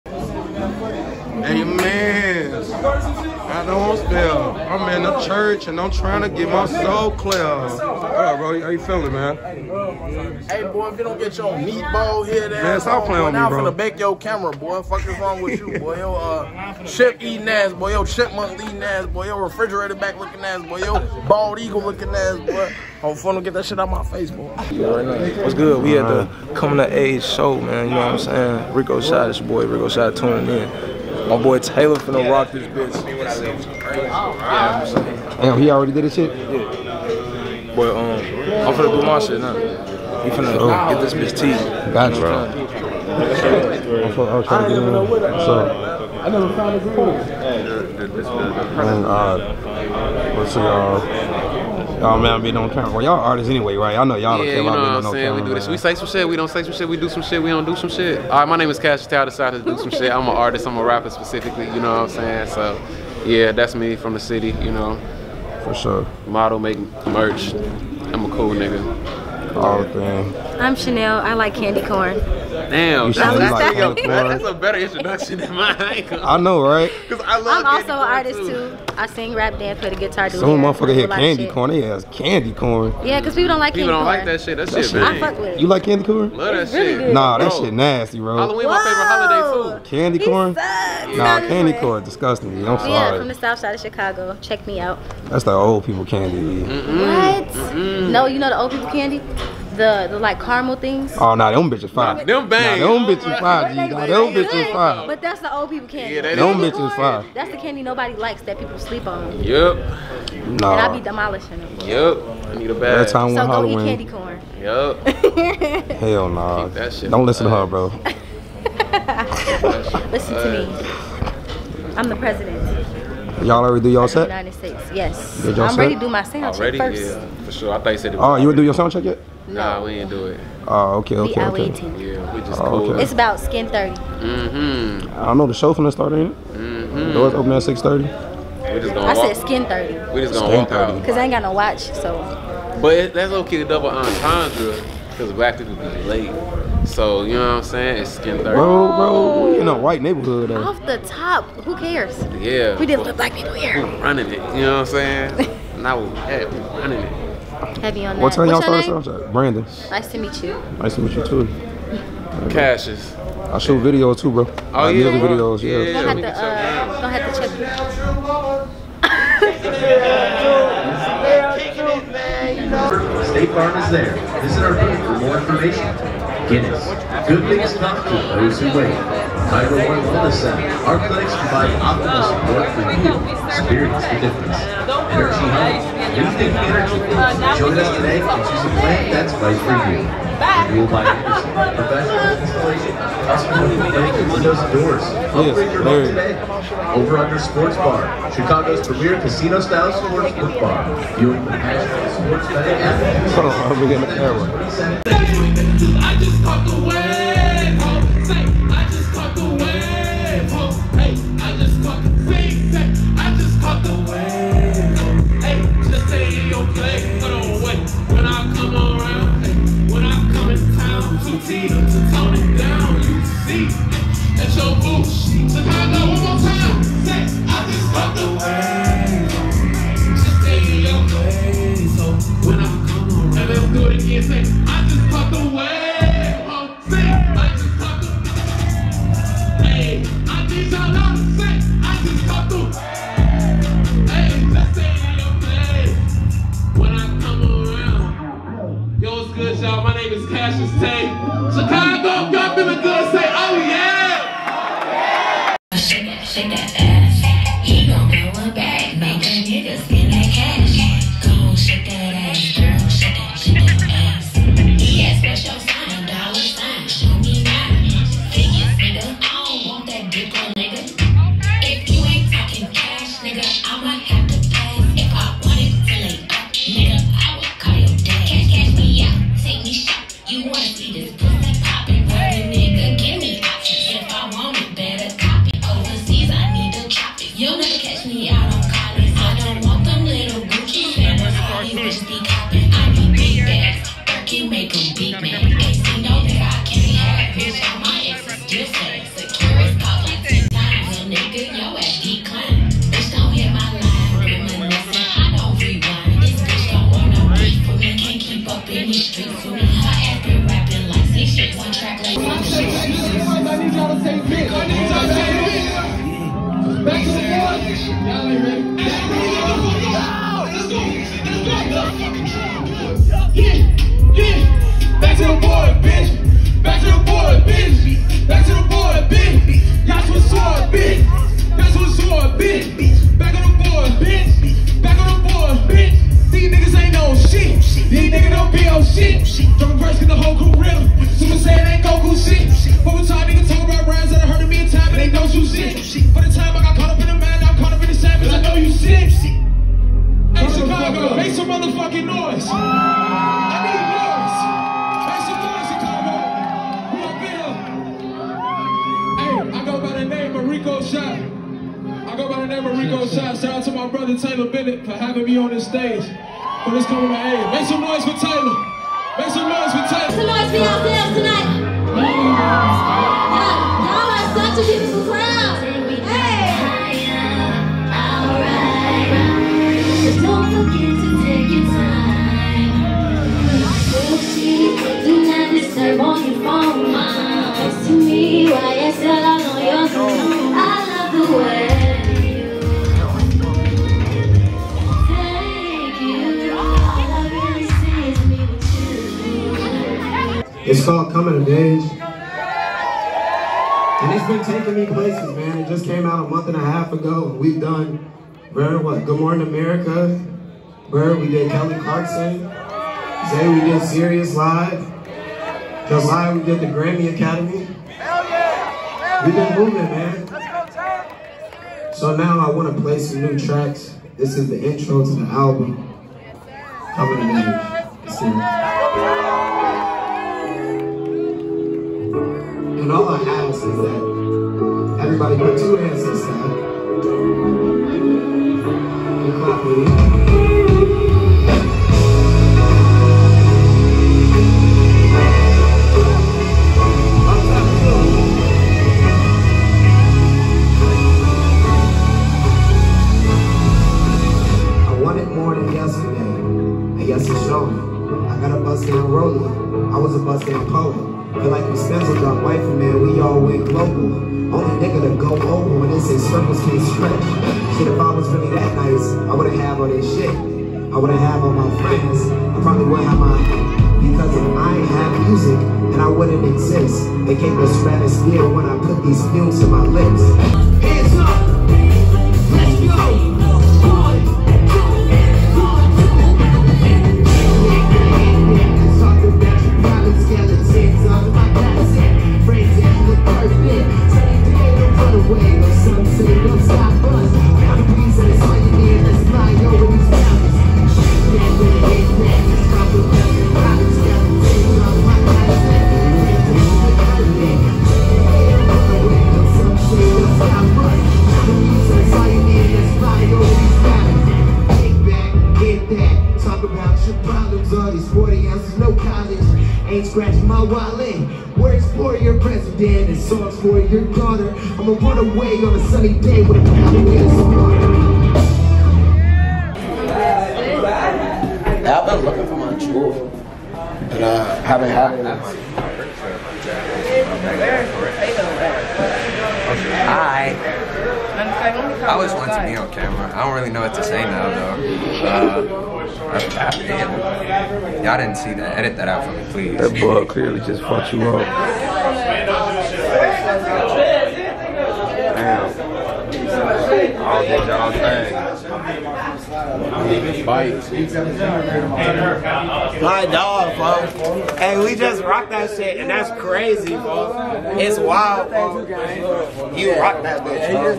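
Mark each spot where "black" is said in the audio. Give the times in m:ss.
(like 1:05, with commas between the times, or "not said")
2:25, 2:33.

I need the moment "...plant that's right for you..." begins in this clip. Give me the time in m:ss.
3:08.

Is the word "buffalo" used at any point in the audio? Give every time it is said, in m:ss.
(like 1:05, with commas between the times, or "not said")
not said.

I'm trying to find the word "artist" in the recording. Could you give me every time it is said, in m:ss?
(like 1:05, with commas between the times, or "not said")
0:53, 1:00, 1:17.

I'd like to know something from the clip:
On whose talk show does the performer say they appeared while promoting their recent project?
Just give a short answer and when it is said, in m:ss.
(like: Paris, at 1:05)
Kelly Clarkson, at 6:51.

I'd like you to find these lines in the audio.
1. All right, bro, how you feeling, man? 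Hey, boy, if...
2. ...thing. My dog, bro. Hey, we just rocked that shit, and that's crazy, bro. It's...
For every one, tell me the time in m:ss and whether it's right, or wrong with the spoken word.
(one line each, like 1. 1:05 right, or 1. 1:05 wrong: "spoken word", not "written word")
1. 0:07 right
2. 9:17 right.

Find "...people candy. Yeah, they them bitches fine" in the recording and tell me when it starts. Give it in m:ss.
1:45.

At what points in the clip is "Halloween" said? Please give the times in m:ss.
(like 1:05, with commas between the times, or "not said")
1:28, 1:53.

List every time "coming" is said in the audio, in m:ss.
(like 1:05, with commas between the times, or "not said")
0:26, 6:06, 6:41, 7:06.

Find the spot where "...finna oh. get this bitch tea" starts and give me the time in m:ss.
0:40.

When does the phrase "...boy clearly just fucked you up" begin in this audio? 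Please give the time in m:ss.
9:10.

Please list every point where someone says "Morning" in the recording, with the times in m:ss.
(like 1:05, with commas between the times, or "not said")
6:49.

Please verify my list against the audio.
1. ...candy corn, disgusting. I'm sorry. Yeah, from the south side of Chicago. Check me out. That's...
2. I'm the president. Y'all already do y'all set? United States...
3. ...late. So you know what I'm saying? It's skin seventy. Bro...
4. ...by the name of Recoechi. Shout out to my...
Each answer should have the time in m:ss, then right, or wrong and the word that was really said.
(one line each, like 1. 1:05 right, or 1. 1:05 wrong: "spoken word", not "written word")
1. 1:31 right
2. 2:01 right
3. 2:26 wrong: "thirty", not "seventy"
4. 6:02 right.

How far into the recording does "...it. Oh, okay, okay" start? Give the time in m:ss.
2:10.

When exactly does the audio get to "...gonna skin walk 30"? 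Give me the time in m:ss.
2:20.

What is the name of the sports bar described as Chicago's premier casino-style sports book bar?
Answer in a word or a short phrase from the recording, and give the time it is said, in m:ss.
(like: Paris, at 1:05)
Over Under Sports Bar, at 3:16.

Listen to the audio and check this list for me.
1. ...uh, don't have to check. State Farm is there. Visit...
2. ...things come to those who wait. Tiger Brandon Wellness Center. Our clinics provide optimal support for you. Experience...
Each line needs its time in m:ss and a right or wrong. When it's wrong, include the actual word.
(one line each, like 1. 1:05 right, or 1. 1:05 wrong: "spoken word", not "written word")
1. 2:46 right
2. 2:57 wrong: "One", not "Brandon".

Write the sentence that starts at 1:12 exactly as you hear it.
Damn, you that's, that's, like that's, that's, a better introduction than mine.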